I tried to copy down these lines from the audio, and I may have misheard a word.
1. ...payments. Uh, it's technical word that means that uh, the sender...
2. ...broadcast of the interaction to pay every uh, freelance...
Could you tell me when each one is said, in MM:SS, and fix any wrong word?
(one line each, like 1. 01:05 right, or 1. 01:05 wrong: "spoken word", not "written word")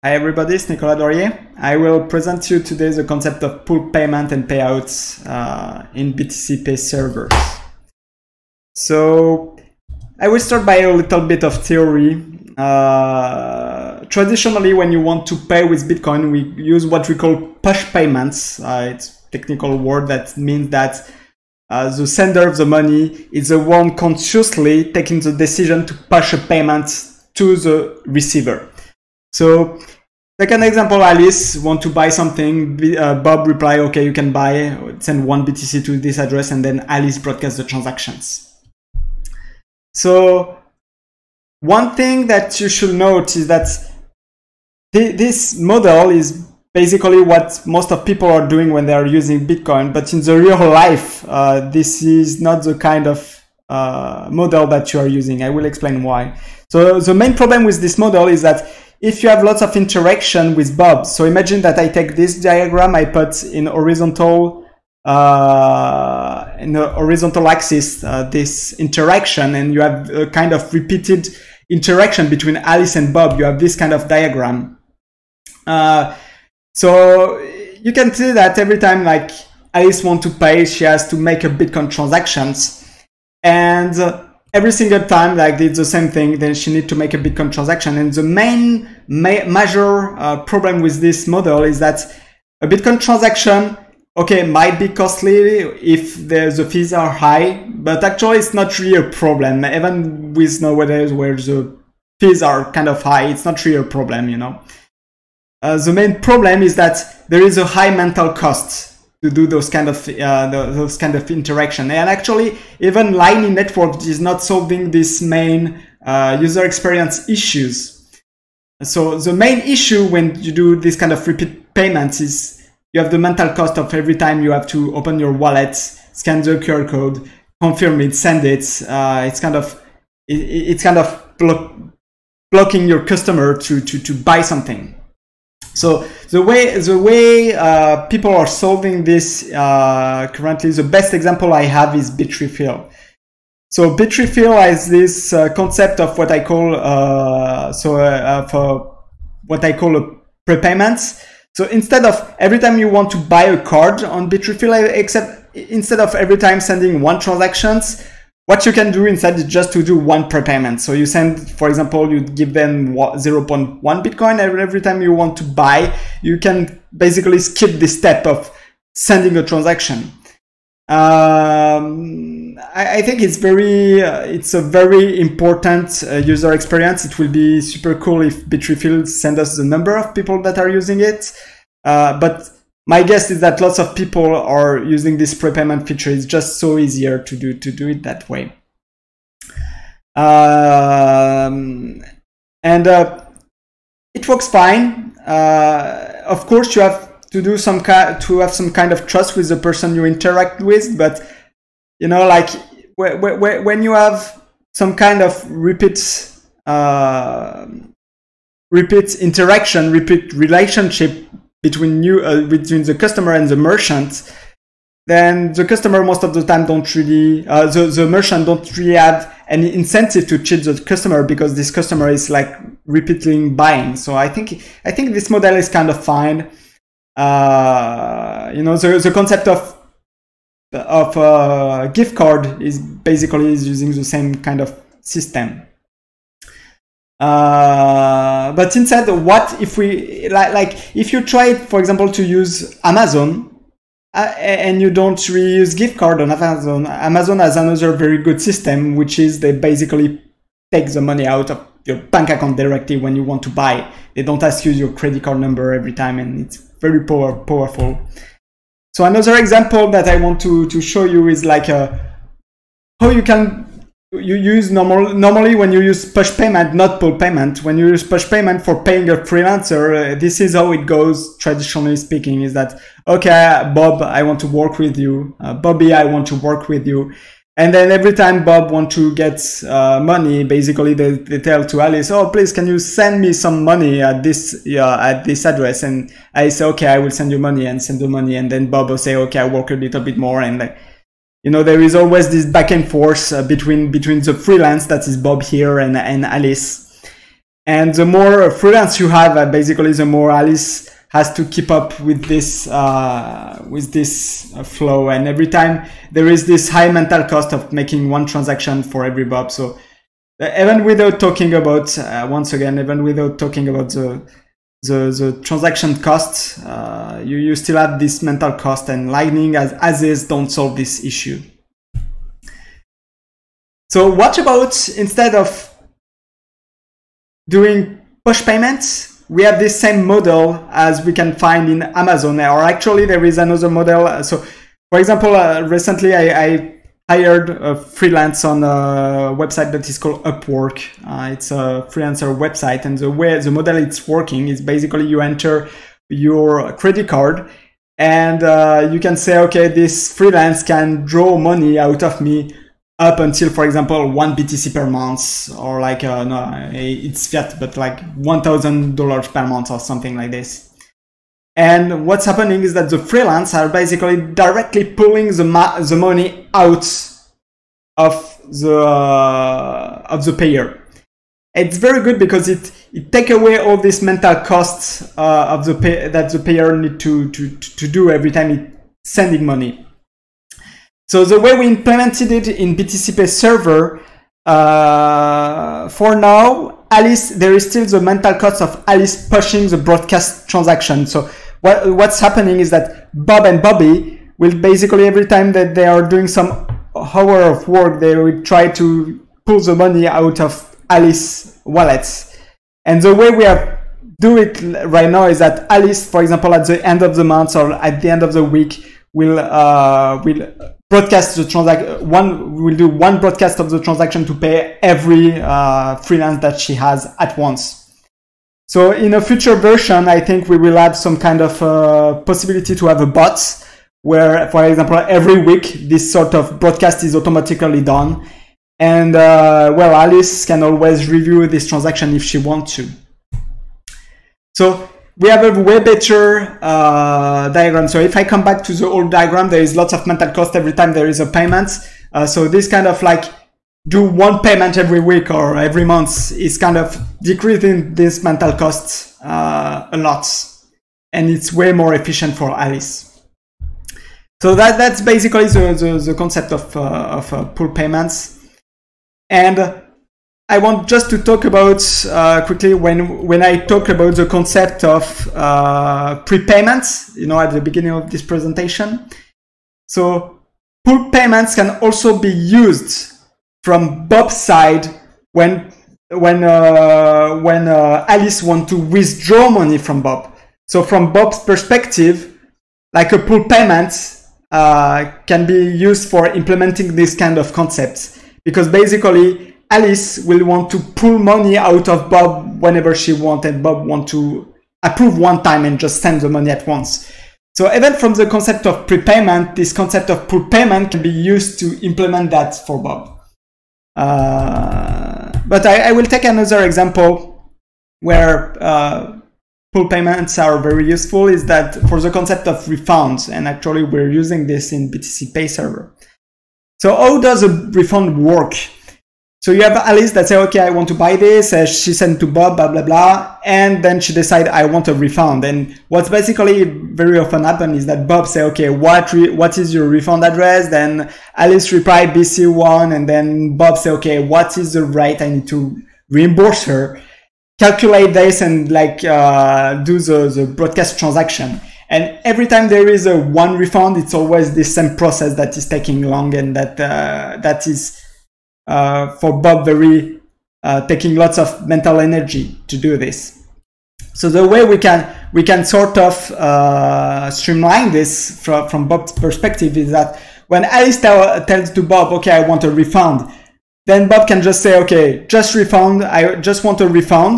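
1. 00:17 right
2. 06:53 wrong: "transaction", not "interaction".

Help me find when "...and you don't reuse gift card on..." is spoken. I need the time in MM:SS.
04:04.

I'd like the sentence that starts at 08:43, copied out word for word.
And then she decide, I want a refund.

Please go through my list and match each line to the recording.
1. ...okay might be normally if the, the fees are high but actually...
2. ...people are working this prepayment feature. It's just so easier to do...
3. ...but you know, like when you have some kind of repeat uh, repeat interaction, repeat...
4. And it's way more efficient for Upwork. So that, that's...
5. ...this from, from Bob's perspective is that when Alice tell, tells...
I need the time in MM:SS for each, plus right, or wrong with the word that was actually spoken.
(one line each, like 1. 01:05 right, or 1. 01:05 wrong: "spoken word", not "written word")
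1. 01:34 wrong: "costly", not "normally"
2. 03:03 wrong: "using", not "working"
3. 03:20 right
4. 07:31 wrong: "Alice", not "Upwork"
5. 09:17 right.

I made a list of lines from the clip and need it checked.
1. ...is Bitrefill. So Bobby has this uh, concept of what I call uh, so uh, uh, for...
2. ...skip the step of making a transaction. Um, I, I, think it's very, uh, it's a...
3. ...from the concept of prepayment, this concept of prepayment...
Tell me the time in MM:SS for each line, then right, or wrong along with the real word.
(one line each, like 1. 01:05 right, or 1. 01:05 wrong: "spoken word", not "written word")
1. 02:21 wrong: "Bitrefill", not "Bobby"
2. 02:47 wrong: "sending", not "making"
3. 08:17 right.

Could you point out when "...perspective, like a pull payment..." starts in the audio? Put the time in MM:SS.
08:01.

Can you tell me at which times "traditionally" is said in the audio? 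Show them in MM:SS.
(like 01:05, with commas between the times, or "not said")
00:14, 04:31.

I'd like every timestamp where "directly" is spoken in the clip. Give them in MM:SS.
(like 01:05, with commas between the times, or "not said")
04:12, 06:04.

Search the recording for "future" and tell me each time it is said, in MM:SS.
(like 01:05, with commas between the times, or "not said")
06:59.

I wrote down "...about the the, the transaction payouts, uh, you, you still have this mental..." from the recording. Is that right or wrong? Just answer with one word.
wrong.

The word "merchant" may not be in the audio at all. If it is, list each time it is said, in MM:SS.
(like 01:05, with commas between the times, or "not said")
03:33, 03:38.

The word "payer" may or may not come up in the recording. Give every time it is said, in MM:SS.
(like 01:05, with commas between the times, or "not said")
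06:10, 06:16.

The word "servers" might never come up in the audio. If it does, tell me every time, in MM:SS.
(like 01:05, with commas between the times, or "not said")
00:06, 06:23, 08:35.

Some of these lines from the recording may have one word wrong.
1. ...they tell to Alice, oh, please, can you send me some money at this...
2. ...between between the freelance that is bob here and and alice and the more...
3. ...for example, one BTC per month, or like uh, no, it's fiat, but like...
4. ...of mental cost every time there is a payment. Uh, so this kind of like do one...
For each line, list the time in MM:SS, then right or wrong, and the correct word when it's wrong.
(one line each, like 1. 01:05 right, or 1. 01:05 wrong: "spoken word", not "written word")
1. 04:41 right
2. 04:53 right
3. 05:53 right
4. 07:19 right.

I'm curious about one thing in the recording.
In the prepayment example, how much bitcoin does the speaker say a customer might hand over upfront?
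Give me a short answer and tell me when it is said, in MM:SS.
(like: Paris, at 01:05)
0.1 Bitcoin, at 02:42.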